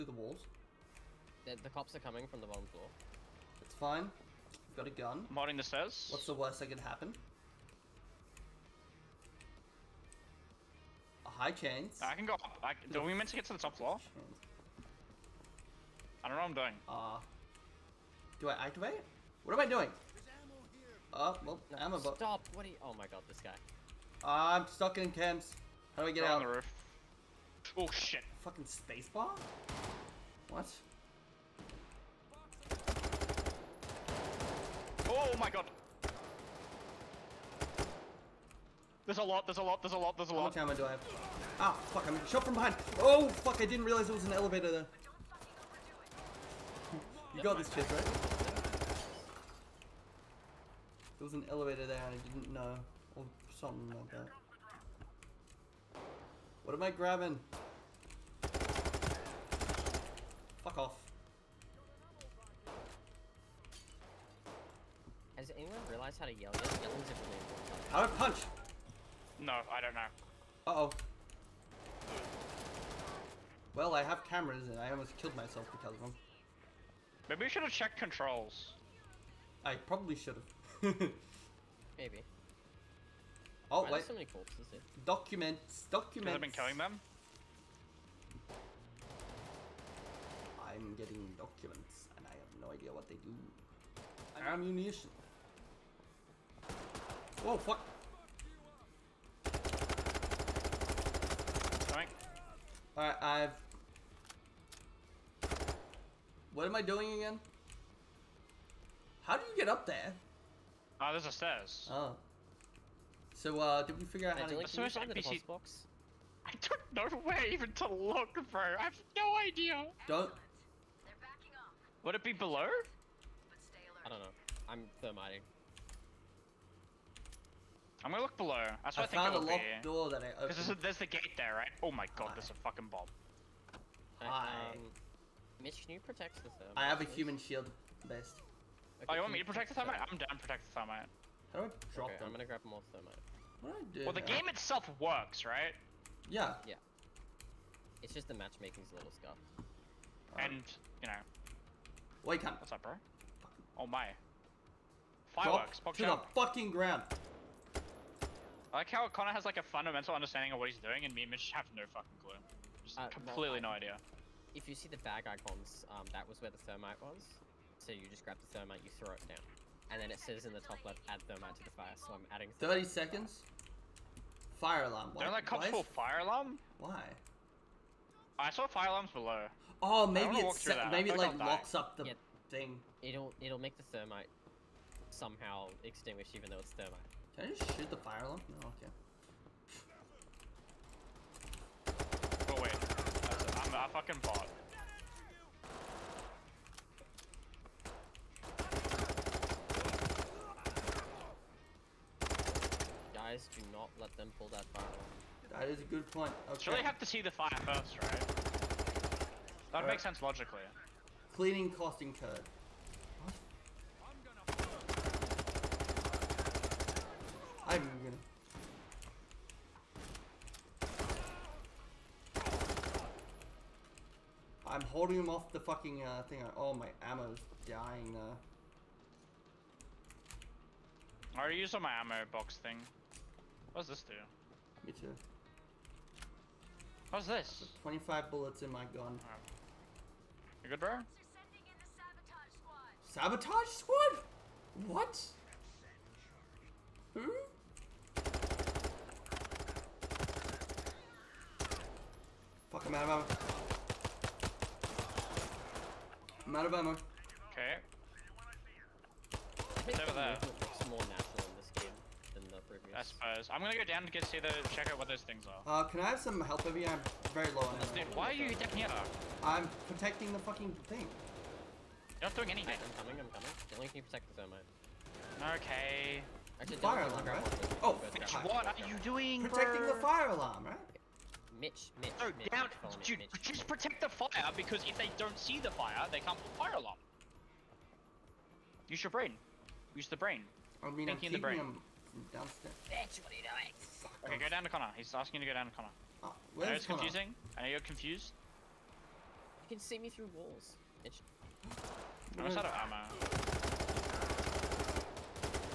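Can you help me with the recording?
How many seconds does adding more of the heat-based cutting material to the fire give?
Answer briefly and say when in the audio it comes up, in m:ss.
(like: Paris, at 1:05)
30, at 2:52.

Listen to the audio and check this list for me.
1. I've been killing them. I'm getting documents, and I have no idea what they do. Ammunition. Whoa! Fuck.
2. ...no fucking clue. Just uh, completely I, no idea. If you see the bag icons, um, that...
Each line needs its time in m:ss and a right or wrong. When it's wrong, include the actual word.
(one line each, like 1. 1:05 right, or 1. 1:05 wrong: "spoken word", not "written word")
1. 1:26 right
2. 2:41 right.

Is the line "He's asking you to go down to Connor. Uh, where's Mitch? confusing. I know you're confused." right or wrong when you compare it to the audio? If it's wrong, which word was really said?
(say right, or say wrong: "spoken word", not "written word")
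wrong: "Connor", not "Mitch".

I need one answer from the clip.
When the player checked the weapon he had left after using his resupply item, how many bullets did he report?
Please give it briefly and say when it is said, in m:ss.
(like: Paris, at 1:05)
25, at 3:57.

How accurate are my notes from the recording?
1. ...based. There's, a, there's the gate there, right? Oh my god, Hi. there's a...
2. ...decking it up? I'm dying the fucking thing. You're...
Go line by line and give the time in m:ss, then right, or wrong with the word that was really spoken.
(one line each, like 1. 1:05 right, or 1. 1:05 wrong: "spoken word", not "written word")
1. 2:10 wrong: "opened", not "based"
2. 4:28 wrong: "protecting", not "dying".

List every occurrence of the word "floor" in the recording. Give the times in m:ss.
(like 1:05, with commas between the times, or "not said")
0:02, 0:13.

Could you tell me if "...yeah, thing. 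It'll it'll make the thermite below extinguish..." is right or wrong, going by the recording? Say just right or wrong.
wrong.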